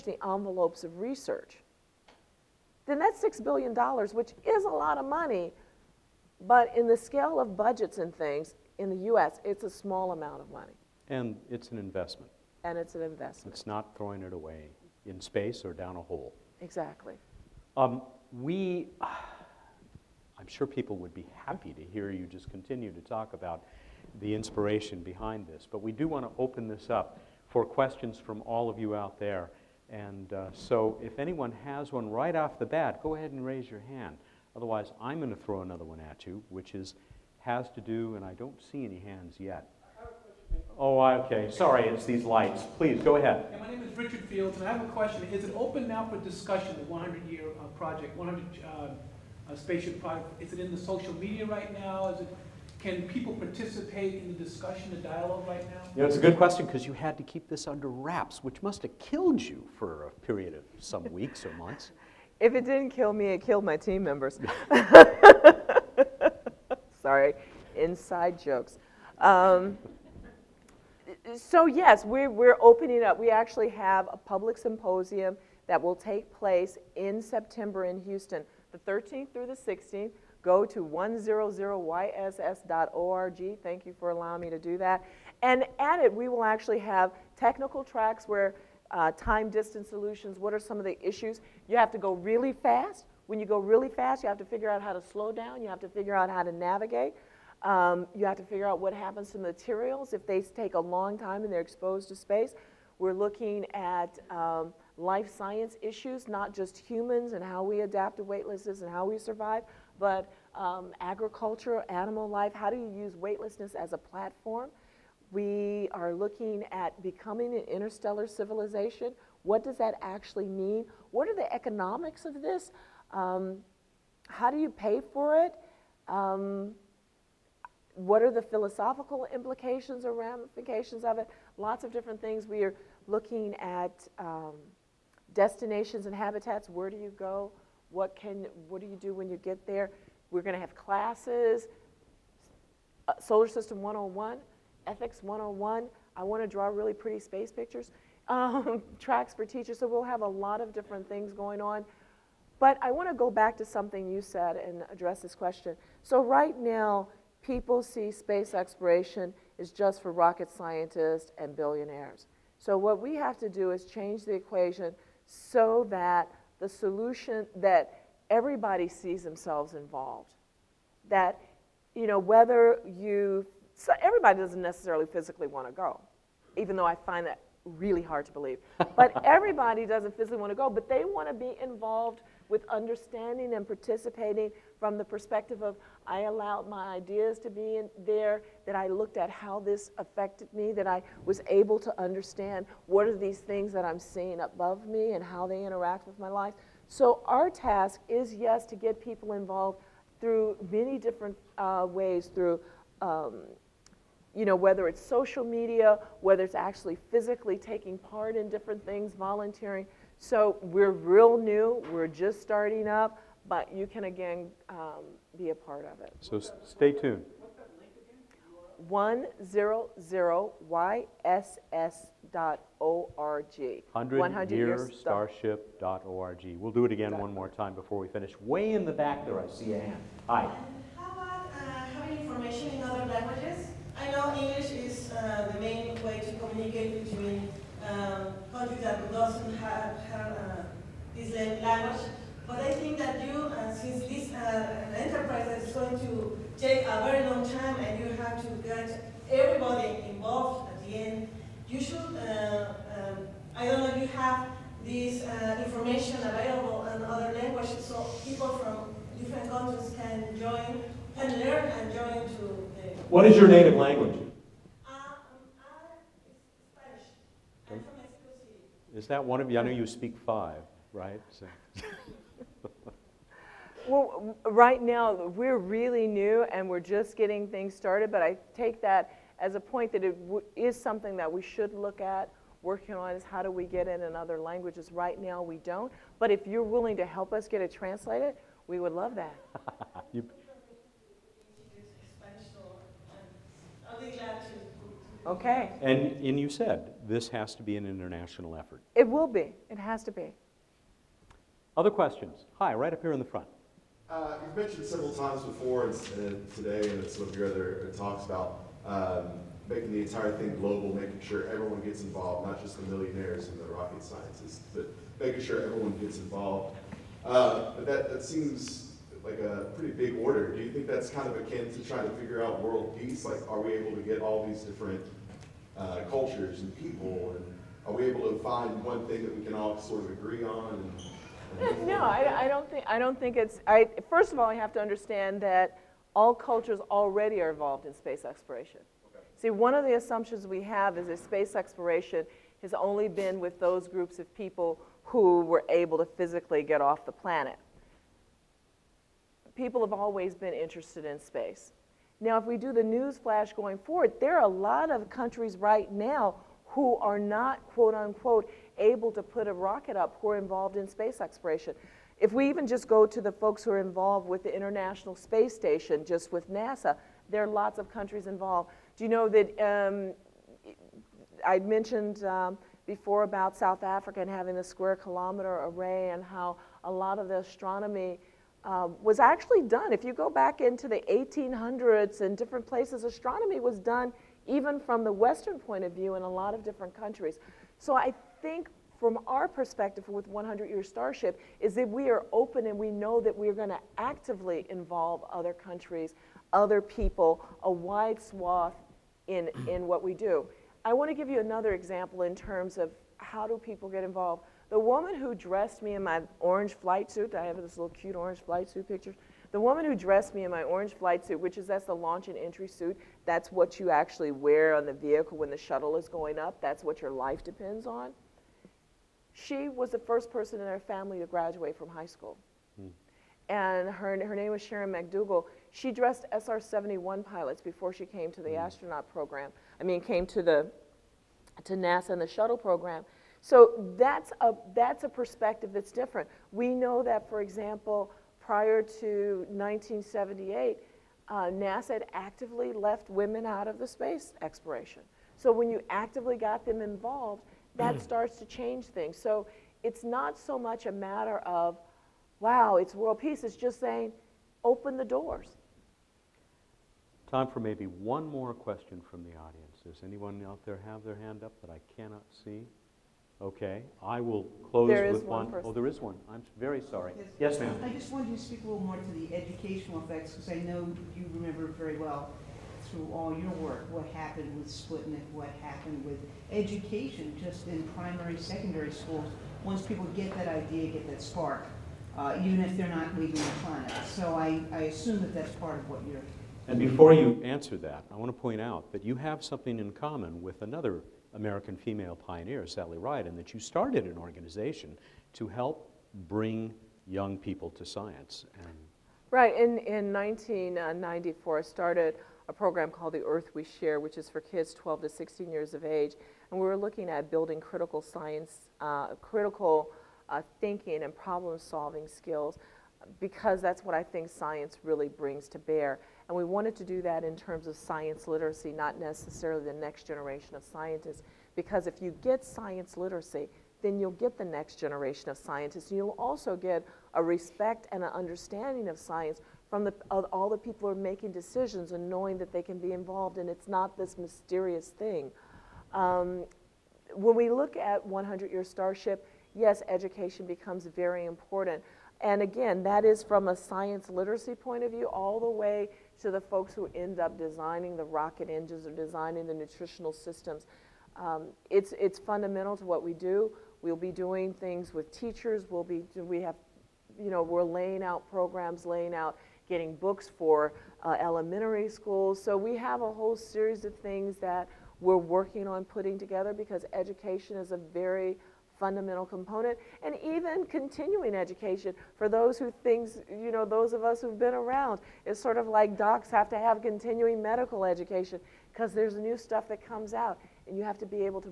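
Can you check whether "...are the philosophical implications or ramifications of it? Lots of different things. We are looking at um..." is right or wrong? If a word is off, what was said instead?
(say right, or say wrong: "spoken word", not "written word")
right.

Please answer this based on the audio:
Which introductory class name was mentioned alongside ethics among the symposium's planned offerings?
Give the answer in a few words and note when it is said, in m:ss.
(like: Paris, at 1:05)
Solar system 101, at 2:23.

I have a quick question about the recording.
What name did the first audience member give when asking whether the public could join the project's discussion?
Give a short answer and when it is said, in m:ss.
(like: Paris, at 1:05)
Richard Fields, at 0:43.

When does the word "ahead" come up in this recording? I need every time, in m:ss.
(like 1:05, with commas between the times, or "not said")
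0:33, 0:43.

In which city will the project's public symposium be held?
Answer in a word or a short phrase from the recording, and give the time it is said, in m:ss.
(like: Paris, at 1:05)
Houston, at 1:18.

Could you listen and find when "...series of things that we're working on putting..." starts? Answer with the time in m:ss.
9:23.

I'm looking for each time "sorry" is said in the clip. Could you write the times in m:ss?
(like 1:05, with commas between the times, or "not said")
0:41, 1:07, 7:46.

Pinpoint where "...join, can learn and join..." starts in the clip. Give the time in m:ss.
4:20.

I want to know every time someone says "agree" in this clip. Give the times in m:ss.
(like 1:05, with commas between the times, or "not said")
5:30.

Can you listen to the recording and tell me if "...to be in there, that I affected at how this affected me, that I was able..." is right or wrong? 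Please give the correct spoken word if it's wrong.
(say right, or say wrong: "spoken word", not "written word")
wrong: "looked", not "affected".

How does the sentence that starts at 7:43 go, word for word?
Okay, I will close there with one.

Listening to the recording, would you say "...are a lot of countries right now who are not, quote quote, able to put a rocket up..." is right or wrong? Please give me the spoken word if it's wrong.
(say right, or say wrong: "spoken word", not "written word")
wrong: "unquote", not "quote".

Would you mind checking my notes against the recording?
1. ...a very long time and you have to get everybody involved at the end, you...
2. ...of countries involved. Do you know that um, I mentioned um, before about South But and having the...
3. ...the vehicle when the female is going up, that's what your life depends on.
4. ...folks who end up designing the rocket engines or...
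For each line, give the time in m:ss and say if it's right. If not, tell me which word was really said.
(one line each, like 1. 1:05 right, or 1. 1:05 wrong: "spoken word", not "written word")
1. 4:06 right
2. 6:07 wrong: "Africa", not "But"
3. 6:54 wrong: "shuttle", not "female"
4. 9:06 right.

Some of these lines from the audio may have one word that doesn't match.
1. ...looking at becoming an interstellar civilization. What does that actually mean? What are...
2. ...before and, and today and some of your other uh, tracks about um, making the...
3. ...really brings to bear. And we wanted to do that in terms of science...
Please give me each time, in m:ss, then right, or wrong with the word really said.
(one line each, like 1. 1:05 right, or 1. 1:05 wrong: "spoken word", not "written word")
1. 1:56 right
2. 5:05 wrong: "talks", not "tracks"
3. 8:34 right.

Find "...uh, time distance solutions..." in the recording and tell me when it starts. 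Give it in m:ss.
1:28.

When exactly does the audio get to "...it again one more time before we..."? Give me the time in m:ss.
3:46.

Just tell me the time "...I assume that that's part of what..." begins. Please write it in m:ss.
8:04.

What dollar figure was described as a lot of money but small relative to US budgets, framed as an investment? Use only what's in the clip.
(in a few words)
$6 billion.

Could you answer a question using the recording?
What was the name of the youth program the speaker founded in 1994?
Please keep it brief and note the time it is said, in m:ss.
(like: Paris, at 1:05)
The Earth We Share, at 8:23.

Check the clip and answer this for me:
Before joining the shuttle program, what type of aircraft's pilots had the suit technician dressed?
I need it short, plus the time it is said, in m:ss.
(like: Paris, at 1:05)
SR-71, at 7:06.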